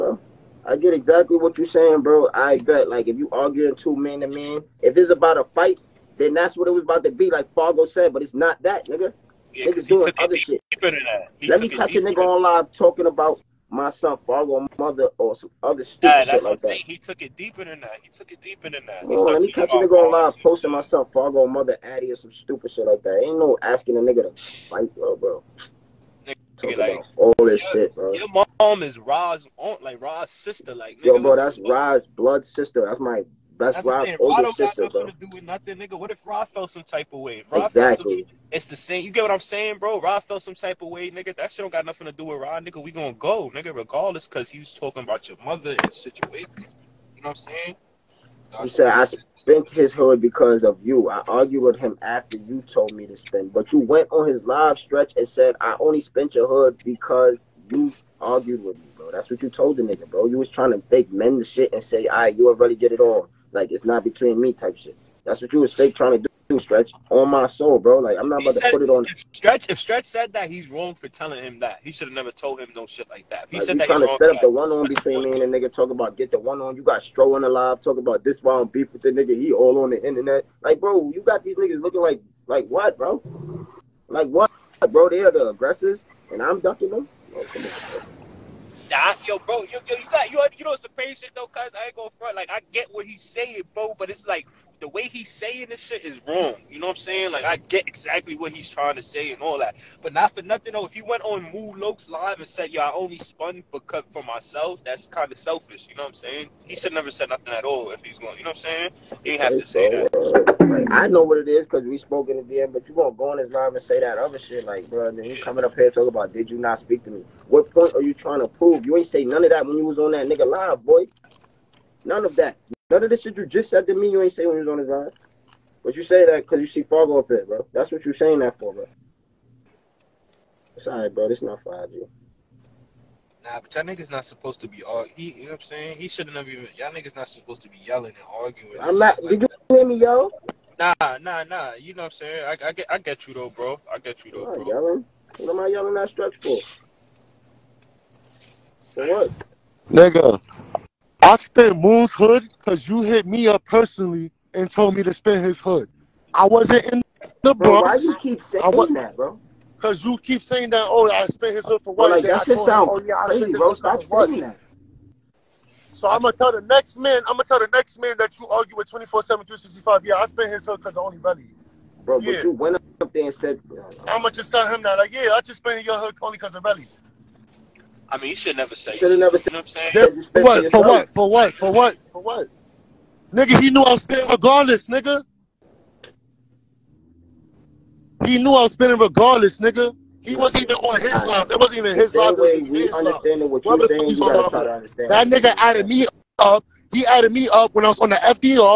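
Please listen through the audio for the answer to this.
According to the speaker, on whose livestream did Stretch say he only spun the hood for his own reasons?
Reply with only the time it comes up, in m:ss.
1:41.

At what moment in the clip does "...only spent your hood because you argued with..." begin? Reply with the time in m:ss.
0:55.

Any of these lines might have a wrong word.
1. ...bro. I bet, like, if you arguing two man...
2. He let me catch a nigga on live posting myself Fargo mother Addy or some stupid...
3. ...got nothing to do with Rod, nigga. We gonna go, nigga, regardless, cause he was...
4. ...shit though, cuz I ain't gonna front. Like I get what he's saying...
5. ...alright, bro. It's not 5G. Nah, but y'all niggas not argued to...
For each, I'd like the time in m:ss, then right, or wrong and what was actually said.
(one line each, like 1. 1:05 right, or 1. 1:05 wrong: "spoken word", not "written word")
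1. 0:02 right
2. 0:19 right
3. 0:41 right
4. 1:31 right
5. 2:10 wrong: "supposed", not "argued".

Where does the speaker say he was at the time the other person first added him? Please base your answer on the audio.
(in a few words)
The FDR.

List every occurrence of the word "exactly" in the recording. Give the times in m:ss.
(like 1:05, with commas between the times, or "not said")
0:00, 0:37, 1:37.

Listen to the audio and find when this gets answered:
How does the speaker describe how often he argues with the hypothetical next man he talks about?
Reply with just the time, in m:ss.
2:48.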